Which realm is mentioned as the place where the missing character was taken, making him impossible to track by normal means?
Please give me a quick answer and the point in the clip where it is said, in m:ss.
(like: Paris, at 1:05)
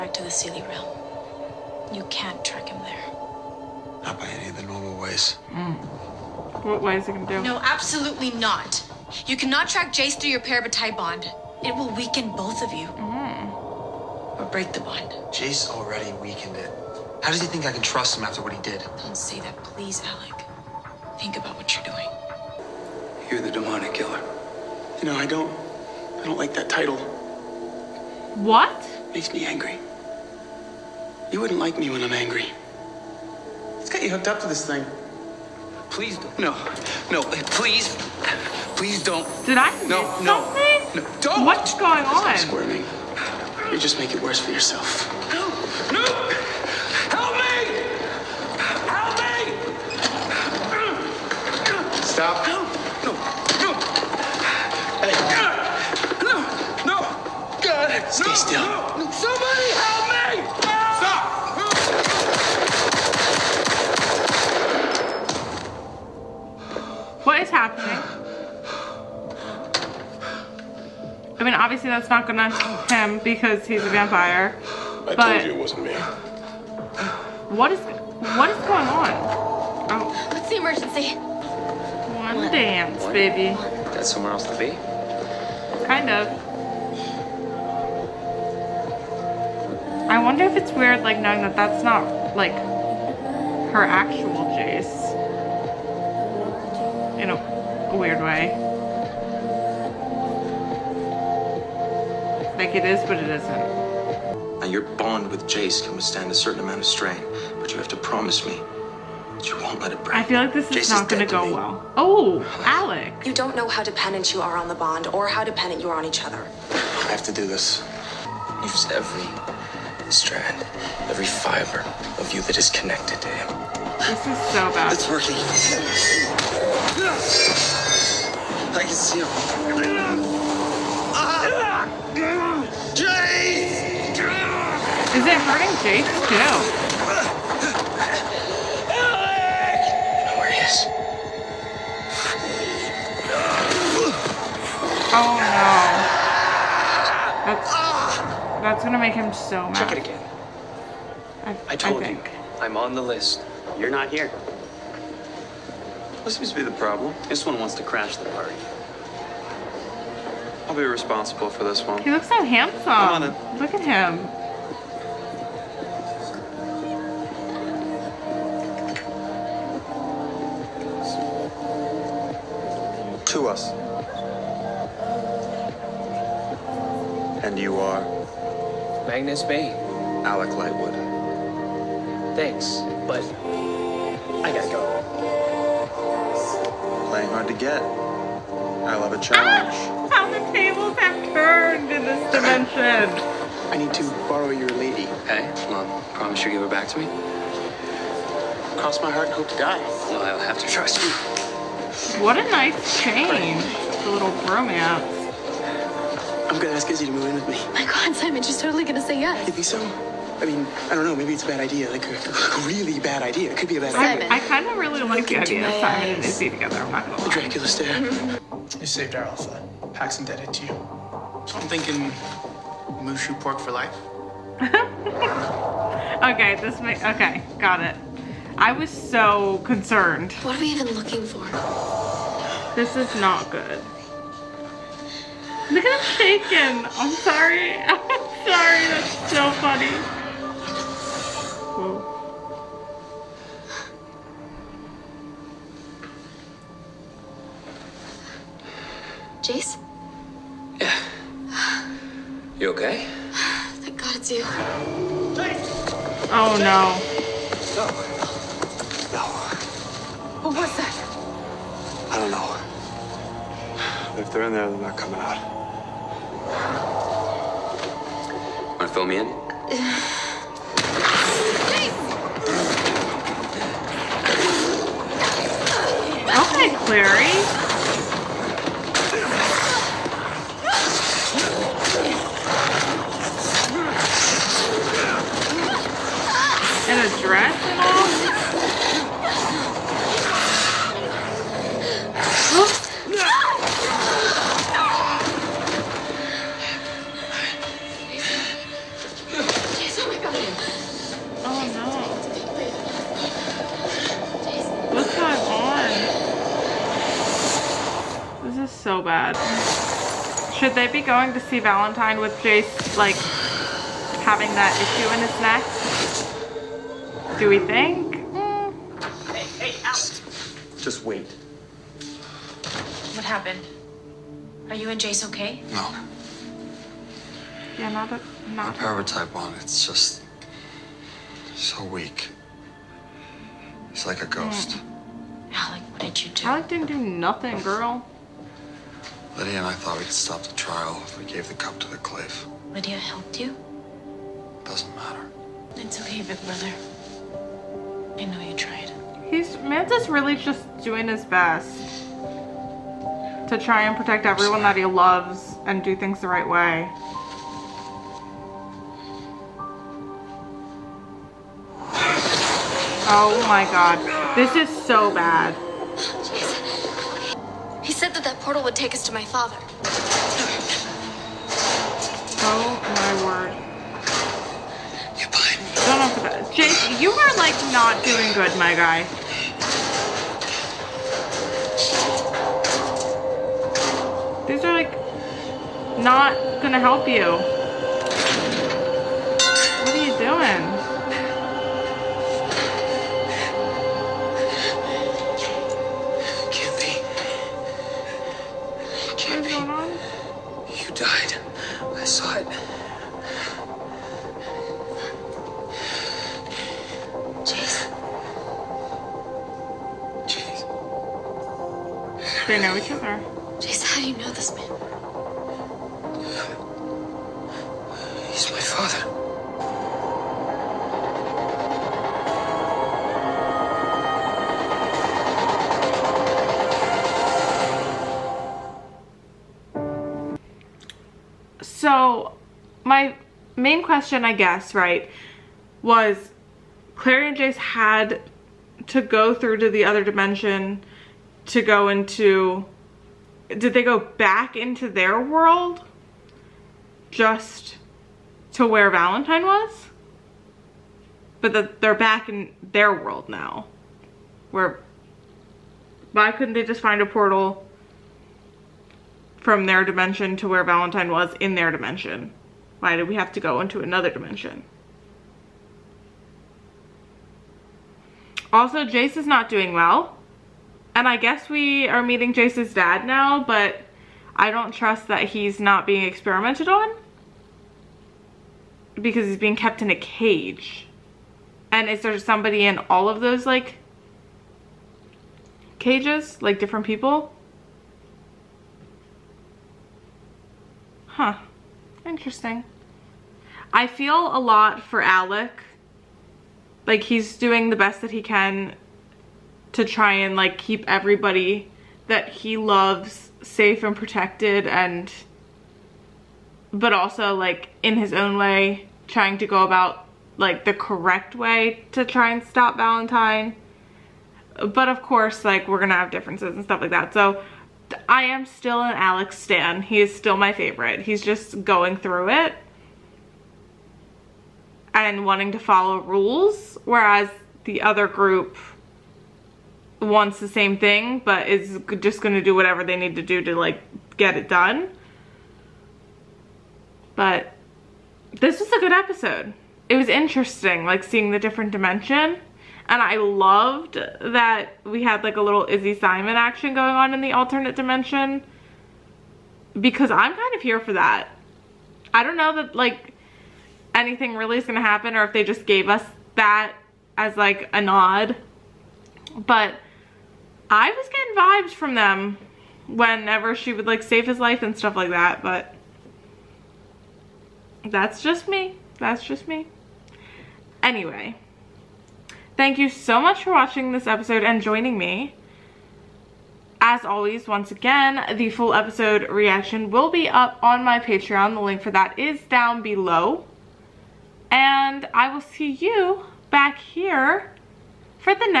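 Seelie Realm, at 0:00.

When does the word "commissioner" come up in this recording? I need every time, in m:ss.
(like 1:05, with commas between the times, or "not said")
not said.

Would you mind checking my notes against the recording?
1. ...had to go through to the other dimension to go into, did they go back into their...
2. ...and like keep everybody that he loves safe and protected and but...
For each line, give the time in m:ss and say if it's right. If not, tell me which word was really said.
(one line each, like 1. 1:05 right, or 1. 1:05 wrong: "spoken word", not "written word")
1. 7:17 right
2. 8:20 right.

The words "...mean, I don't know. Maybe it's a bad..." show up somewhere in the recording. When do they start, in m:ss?
3:30.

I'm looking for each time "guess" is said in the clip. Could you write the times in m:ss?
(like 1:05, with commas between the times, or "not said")
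7:14, 7:51.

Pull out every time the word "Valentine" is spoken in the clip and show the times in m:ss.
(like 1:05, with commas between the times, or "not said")
5:11, 7:28, 7:40, 8:32.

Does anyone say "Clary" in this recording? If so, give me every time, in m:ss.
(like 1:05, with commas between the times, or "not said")
4:36, 7:16.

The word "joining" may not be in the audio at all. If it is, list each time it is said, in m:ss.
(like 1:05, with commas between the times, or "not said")
9:34.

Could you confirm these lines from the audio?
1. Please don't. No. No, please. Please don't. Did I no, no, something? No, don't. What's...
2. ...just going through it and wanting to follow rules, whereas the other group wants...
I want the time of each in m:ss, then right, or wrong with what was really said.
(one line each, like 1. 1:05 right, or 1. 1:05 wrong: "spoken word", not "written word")
1. 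0:35 right
2. 8:41 right.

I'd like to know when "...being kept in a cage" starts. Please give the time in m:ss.
7:59.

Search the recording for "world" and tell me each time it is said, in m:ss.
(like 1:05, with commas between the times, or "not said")
7:25, 7:32.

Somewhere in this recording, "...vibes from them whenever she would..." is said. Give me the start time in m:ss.
9:21.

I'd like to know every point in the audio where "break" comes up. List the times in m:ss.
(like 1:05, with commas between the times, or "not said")
0:14, 1:50.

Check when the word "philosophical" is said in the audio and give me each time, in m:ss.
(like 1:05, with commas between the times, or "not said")
not said.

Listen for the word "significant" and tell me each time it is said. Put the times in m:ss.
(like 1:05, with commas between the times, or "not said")
not said.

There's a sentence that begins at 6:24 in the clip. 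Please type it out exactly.
These are like not gonna help you.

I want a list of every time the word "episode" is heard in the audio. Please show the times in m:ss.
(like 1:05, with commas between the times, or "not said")
8:58, 9:34, 9:38.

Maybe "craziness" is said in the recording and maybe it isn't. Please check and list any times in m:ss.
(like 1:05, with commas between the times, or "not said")
not said.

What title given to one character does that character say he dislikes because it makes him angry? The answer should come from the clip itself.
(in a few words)
demonic killer.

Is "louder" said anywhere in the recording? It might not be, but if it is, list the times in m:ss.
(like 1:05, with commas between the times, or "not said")
not said.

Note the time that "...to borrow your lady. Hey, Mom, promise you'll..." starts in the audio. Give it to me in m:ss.
3:13.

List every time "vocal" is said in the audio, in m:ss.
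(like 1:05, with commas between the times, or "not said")
not said.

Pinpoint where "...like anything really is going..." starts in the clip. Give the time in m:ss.
9:12.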